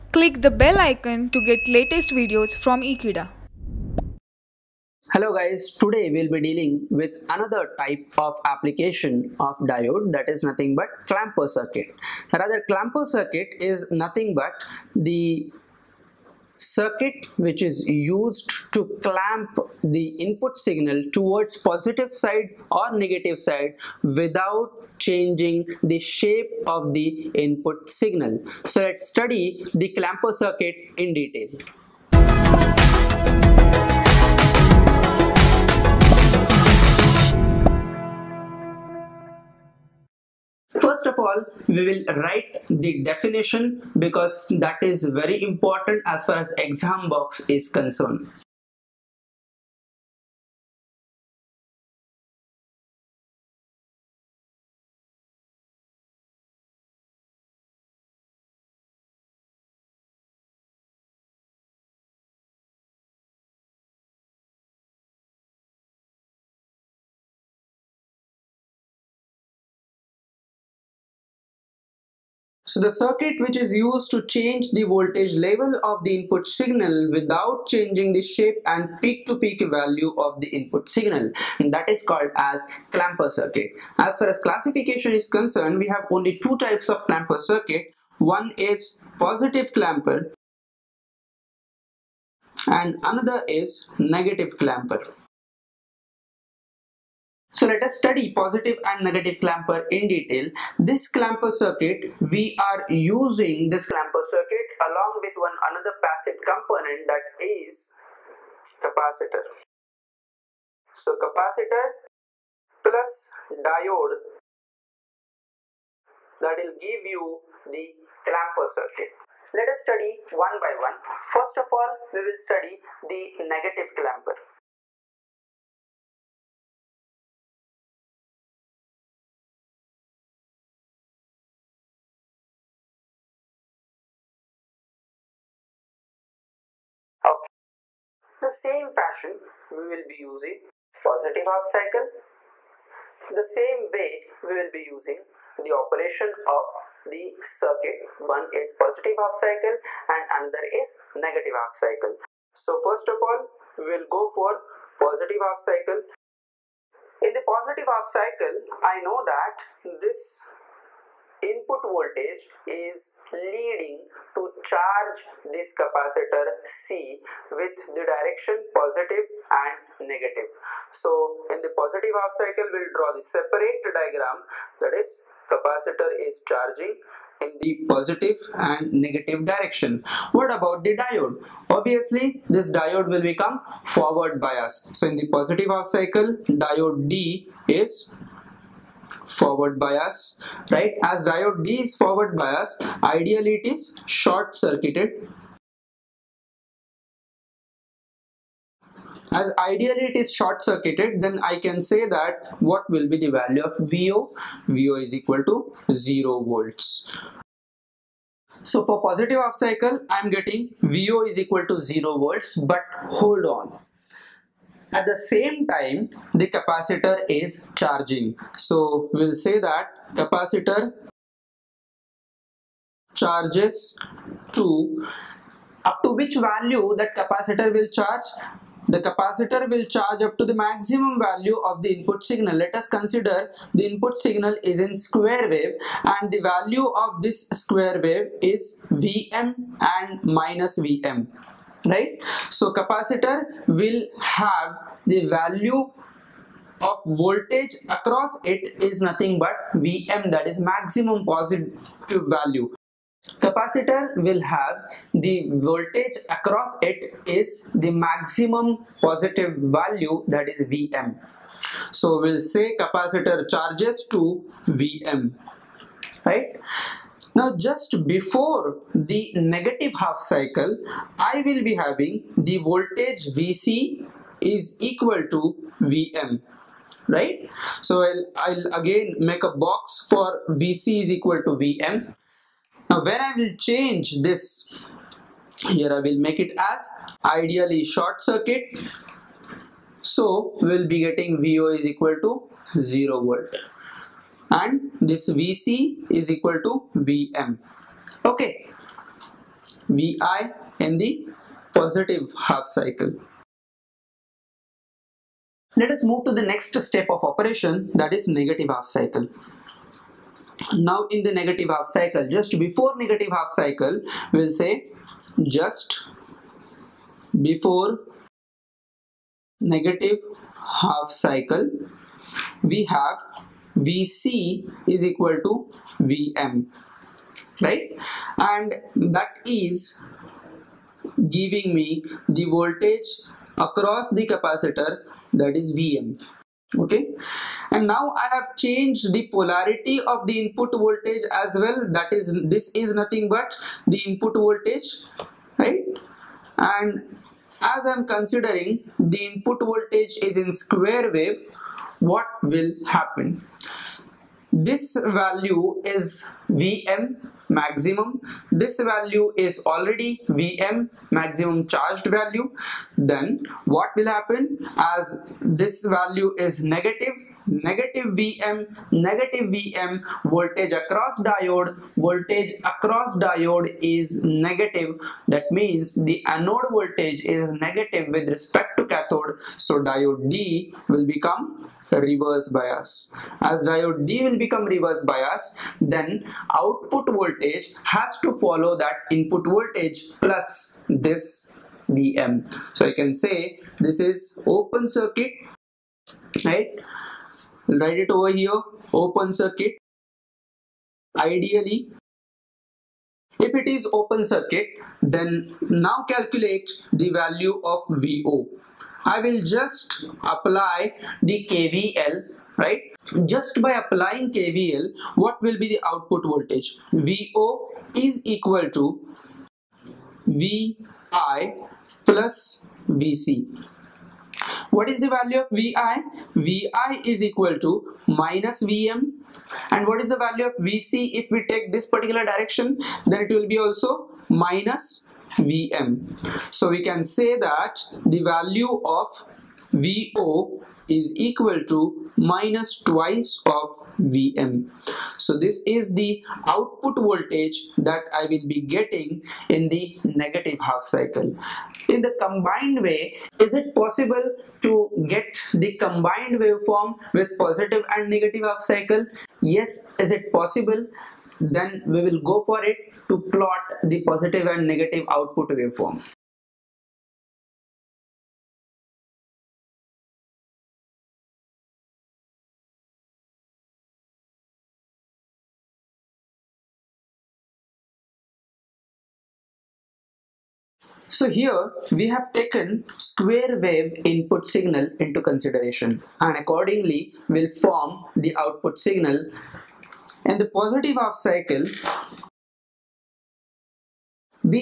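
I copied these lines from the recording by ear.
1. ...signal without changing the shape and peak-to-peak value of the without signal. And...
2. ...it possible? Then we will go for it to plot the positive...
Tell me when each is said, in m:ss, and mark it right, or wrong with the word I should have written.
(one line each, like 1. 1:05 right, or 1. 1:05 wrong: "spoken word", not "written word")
1. 1:16 wrong: "input", not "without"
2. 7:40 right.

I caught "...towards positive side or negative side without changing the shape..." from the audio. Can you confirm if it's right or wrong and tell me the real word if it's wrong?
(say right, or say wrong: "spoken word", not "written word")
right.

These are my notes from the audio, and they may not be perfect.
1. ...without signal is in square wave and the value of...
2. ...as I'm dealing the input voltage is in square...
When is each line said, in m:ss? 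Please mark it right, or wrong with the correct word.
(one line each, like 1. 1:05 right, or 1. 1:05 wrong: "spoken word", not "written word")
1. 3:53 wrong: "input", not "without"
2. 5:47 wrong: "considering", not "dealing".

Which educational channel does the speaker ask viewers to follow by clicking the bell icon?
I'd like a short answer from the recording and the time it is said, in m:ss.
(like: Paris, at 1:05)
Ekeeda, at 0:02.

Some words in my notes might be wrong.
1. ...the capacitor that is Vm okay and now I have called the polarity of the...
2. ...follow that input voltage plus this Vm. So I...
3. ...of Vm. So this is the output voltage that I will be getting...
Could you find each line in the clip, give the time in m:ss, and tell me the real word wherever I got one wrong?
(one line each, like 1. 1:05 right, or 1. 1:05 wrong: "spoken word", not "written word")
1. 5:34 wrong: "changed", not "called"
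2. 6:28 right
3. 7:23 right.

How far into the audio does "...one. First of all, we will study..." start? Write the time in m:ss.
2:00.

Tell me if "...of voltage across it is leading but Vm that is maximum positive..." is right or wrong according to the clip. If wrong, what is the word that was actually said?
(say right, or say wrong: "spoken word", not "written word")
wrong: "nothing", not "leading".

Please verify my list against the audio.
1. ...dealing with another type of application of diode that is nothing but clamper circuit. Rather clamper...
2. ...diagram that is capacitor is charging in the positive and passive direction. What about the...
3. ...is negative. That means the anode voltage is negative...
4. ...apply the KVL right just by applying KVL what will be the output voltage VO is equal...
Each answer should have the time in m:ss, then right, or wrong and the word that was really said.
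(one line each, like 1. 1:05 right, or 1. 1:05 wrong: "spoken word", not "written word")
1. 0:06 right
2. 2:53 wrong: "negative", not "passive"
3. 6:13 right
4. 6:50 right.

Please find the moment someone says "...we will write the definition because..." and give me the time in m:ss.
0:41.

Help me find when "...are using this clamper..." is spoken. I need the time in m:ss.
1:42.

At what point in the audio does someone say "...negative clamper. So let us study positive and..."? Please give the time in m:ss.
1:33.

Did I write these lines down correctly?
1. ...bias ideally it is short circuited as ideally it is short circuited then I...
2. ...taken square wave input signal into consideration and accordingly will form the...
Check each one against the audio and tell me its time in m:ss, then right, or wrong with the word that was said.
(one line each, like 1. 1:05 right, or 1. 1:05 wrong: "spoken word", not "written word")
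1. 3:12 right
2. 8:02 right.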